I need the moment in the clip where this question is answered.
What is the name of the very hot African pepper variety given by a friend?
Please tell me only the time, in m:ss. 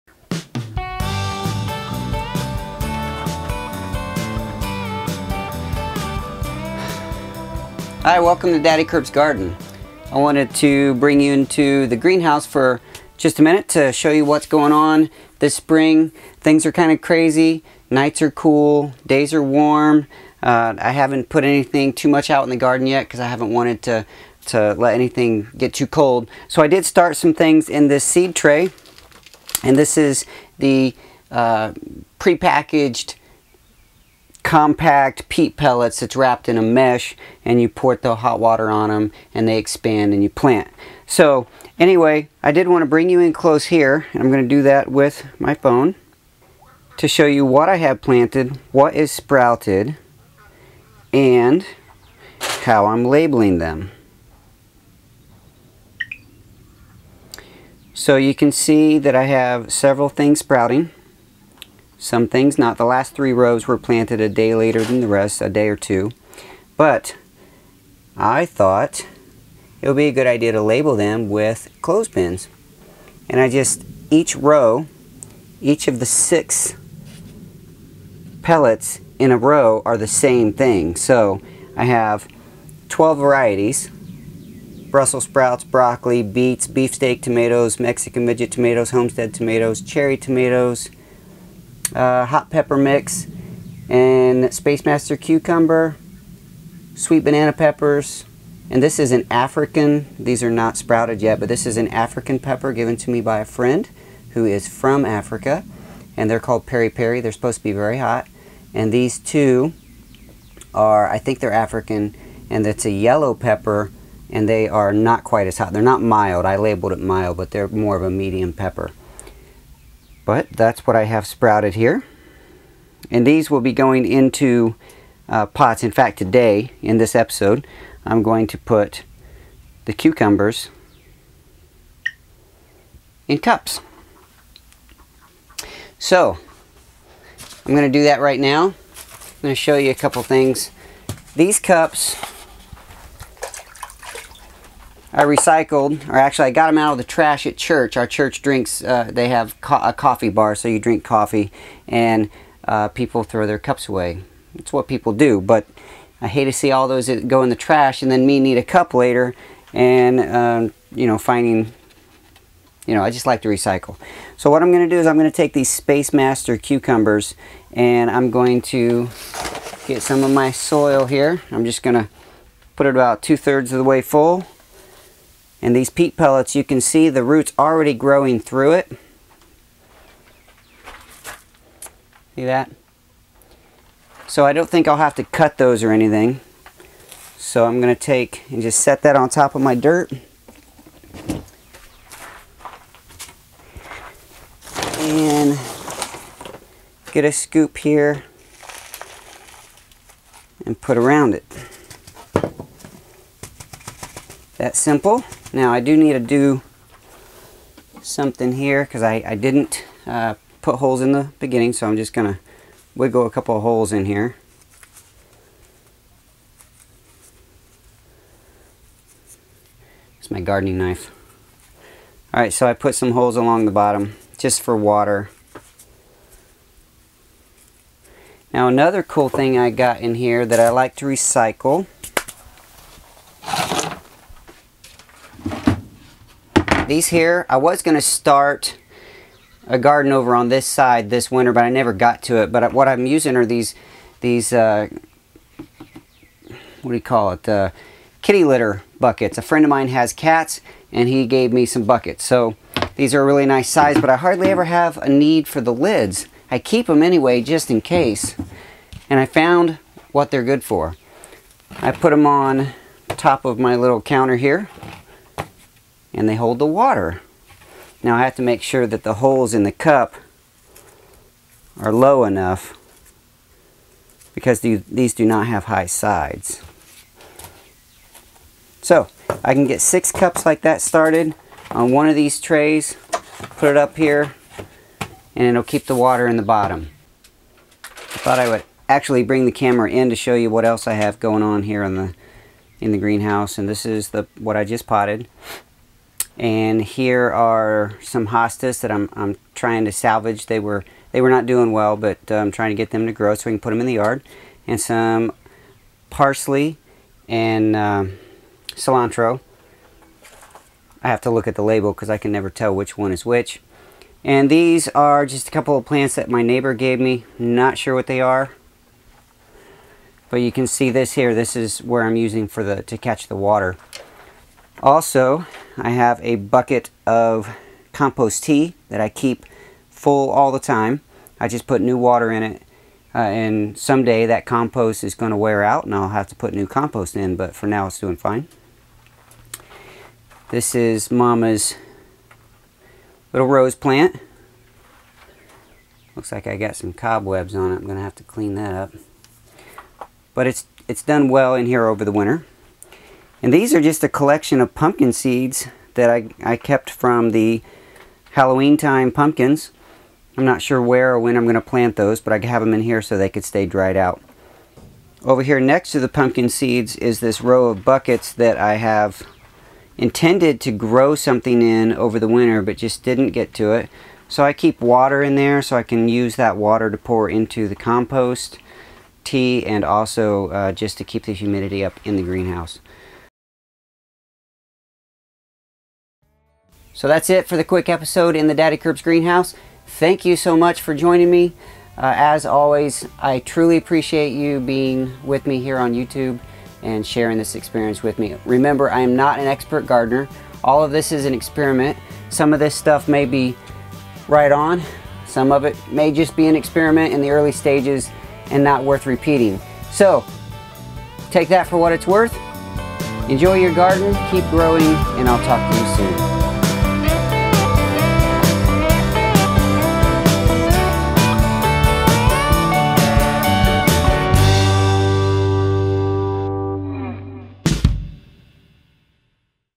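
1:46.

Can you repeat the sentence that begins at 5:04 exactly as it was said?
And some parsley and um, cilantro.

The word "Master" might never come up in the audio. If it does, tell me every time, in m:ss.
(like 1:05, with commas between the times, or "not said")
1:34, 2:46.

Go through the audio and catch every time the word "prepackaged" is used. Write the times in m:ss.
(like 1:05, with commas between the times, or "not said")
0:32.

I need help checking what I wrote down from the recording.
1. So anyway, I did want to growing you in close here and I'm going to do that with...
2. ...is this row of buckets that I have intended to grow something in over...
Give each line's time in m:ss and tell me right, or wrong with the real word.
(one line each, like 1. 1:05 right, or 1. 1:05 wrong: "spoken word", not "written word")
1. 0:41 wrong: "bring", not "growing"
2. 6:06 right.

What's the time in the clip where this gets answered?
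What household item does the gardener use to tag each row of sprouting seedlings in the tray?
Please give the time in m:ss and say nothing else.
1:11.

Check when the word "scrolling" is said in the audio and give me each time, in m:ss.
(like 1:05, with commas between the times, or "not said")
not said.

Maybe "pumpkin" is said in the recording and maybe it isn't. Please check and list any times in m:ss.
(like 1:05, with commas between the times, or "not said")
5:54, 5:59, 6:06.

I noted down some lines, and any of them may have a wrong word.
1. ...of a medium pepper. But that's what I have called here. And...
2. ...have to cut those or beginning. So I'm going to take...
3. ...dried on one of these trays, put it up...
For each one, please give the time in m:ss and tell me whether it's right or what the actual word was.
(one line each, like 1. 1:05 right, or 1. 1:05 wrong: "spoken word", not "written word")
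1. 1:57 wrong: "sprouted", not "called"
2. 3:04 wrong: "anything", not "beginning"
3. 4:40 wrong: "started", not "dried".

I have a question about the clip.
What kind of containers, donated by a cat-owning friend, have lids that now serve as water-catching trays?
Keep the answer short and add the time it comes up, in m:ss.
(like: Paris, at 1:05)
Kitty litter buckets, at 4:08.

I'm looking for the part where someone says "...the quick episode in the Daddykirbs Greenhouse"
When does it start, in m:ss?
6:27.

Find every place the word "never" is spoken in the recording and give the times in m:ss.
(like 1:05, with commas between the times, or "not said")
4:01, 5:12.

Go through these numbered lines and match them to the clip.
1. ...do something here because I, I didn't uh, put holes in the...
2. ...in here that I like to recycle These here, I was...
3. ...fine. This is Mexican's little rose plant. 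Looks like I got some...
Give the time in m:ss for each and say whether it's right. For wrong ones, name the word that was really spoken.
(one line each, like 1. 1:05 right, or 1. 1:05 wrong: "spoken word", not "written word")
1. 3:26 right
2. 3:49 right
3. 5:38 wrong: "Mama", not "Mexican".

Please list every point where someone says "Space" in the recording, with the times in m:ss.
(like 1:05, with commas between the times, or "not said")
1:34, 2:45.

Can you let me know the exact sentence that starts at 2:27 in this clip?
Our church drinks, uh, they have co a coffee bar, so you drink coffee, and uh, people throw their cups away.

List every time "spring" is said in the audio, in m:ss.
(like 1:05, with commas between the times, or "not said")
0:15.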